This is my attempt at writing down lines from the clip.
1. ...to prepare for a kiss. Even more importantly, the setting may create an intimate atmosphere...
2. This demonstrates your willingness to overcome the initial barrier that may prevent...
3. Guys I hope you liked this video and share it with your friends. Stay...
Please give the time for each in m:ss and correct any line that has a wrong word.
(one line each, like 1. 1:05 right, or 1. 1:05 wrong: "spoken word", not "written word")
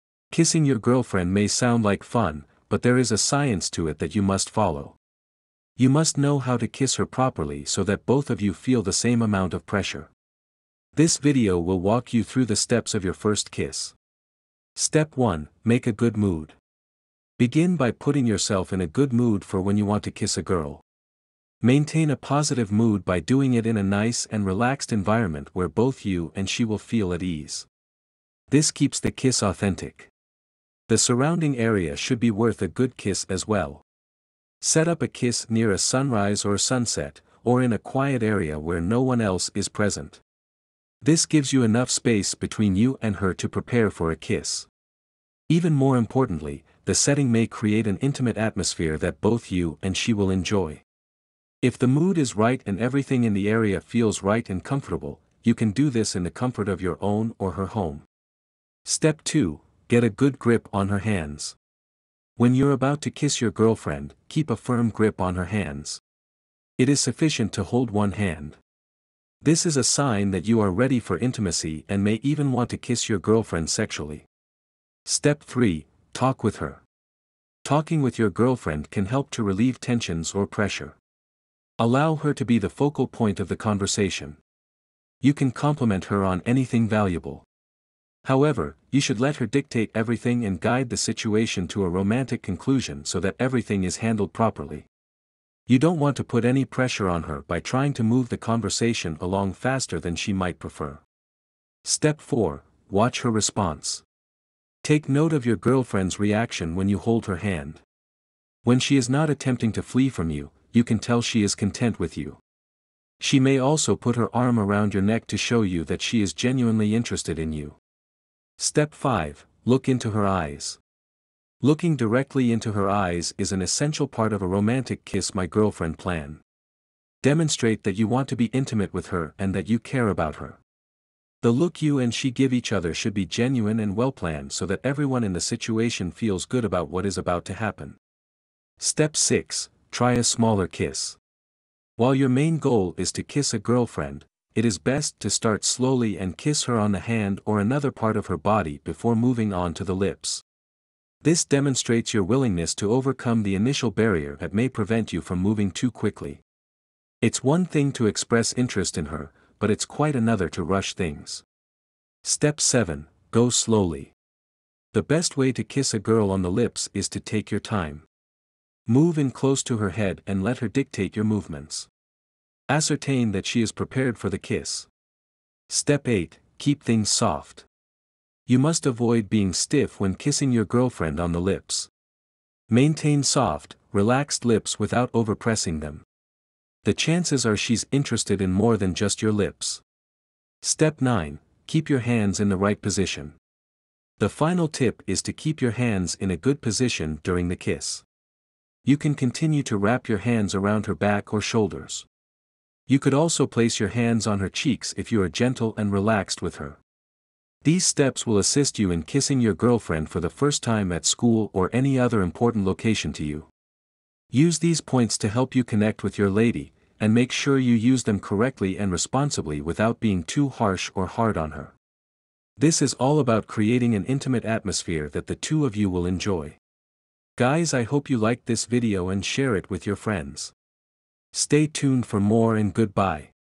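1. 0:43 right
2. 2:31 right
3. 3:47 right.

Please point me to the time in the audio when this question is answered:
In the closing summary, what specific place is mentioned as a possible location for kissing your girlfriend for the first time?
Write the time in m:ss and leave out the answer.
3:31.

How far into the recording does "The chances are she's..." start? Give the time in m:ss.
3:06.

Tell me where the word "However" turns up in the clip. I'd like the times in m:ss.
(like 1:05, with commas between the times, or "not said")
1:28.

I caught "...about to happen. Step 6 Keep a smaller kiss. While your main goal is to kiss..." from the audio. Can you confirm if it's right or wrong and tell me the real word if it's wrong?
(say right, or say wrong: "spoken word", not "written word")
wrong: "Try", not "Keep".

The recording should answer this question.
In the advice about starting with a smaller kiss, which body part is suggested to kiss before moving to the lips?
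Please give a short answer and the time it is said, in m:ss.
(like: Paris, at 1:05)
The hand, at 2:26.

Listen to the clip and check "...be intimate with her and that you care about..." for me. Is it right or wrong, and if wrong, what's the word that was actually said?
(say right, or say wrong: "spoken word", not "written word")
right.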